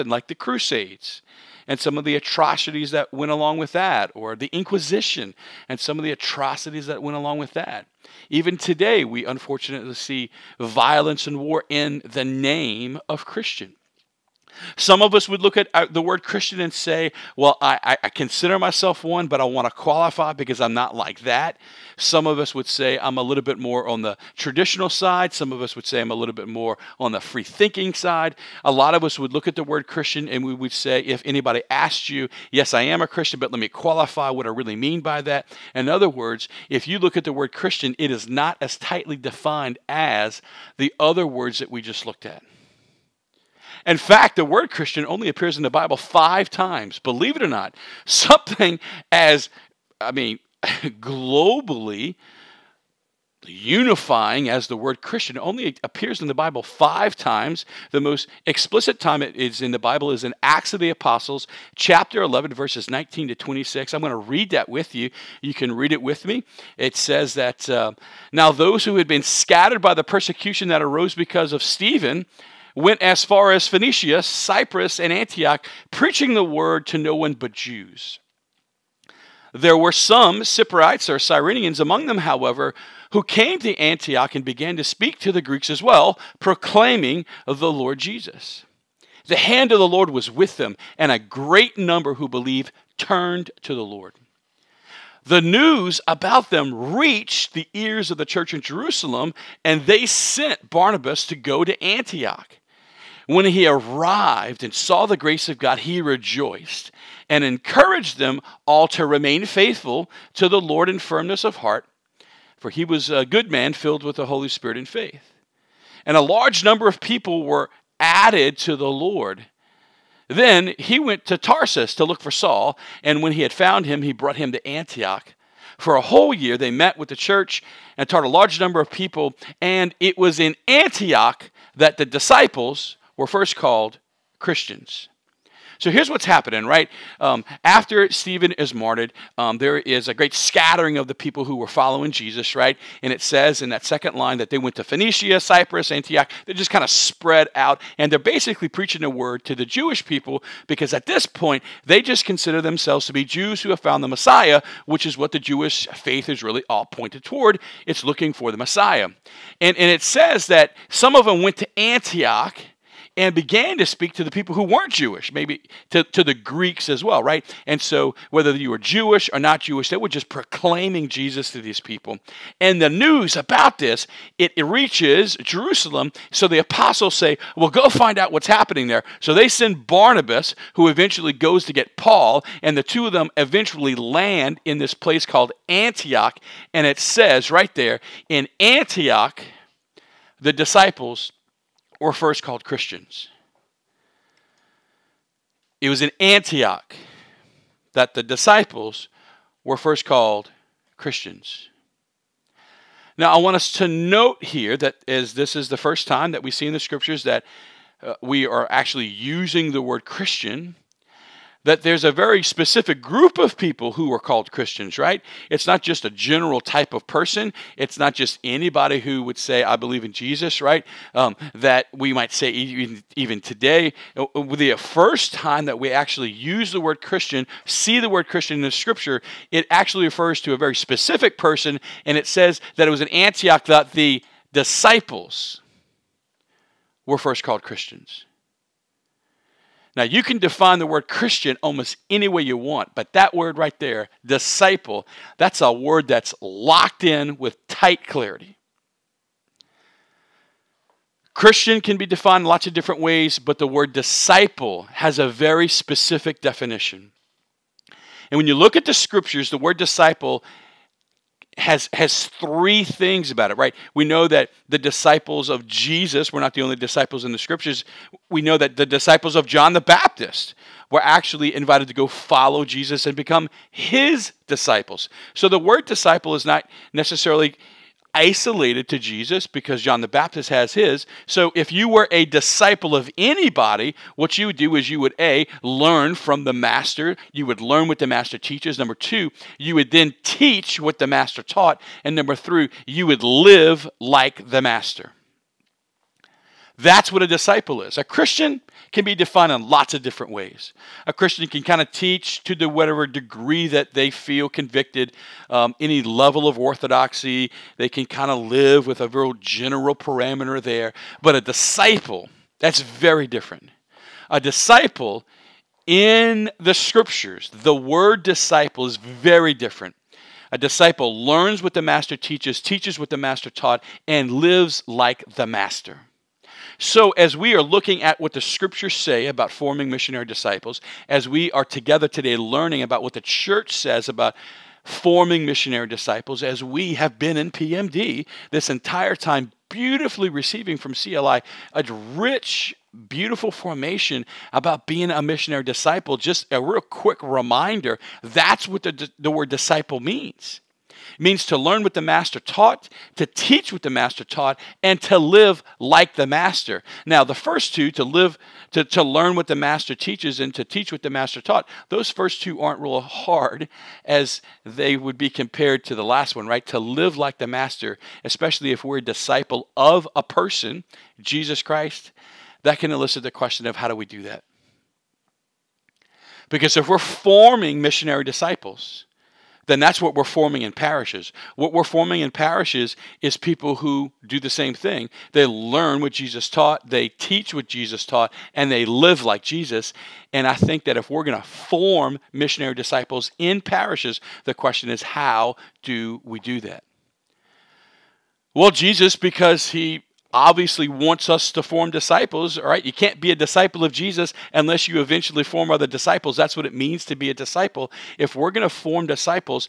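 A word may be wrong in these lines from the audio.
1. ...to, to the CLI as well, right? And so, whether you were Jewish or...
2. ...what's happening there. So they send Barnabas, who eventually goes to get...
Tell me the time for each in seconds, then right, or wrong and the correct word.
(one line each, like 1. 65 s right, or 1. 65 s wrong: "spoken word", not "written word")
1. 165 s wrong: "Greeks", not "CLI"
2. 178 s right.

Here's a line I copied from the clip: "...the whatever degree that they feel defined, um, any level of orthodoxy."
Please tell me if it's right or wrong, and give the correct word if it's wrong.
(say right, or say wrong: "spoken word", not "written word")
wrong: "convicted", not "defined".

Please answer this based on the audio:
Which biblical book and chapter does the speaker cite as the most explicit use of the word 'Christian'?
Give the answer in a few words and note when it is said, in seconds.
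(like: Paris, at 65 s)
Acts chapter 11, at 60 s.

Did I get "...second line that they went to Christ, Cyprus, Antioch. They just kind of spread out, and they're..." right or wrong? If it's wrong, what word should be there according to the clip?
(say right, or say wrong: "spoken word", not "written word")
wrong: "Phoenicia", not "Christ".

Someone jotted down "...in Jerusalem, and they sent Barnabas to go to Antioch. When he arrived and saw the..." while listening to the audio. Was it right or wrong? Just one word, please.
right.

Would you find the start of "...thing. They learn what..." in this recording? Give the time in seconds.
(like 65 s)
384 s.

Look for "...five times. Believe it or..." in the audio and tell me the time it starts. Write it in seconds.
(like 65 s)
45 s.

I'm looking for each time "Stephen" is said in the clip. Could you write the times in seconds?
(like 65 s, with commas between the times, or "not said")
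71 s, 138 s.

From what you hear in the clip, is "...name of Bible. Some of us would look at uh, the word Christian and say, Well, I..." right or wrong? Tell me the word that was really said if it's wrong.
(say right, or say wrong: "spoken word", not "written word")
wrong: "Christian", not "Bible".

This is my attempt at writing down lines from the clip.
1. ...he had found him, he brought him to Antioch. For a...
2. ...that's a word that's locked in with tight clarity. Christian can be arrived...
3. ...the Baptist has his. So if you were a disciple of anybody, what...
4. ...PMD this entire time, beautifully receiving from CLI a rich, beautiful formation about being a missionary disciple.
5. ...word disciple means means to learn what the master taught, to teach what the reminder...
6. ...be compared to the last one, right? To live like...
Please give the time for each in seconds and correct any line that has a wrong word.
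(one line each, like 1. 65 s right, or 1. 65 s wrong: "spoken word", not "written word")
1. 123 s right
2. 245 s wrong: "defined", not "arrived"
3. 280 s right
4. 337 s right
5. 349 s wrong: "master", not "reminder"
6. 365 s right.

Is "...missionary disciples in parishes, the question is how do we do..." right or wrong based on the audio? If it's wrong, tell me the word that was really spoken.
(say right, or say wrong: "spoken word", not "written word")
right.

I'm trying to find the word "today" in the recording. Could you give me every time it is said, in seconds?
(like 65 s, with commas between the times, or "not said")
8 s, 223 s, 332 s.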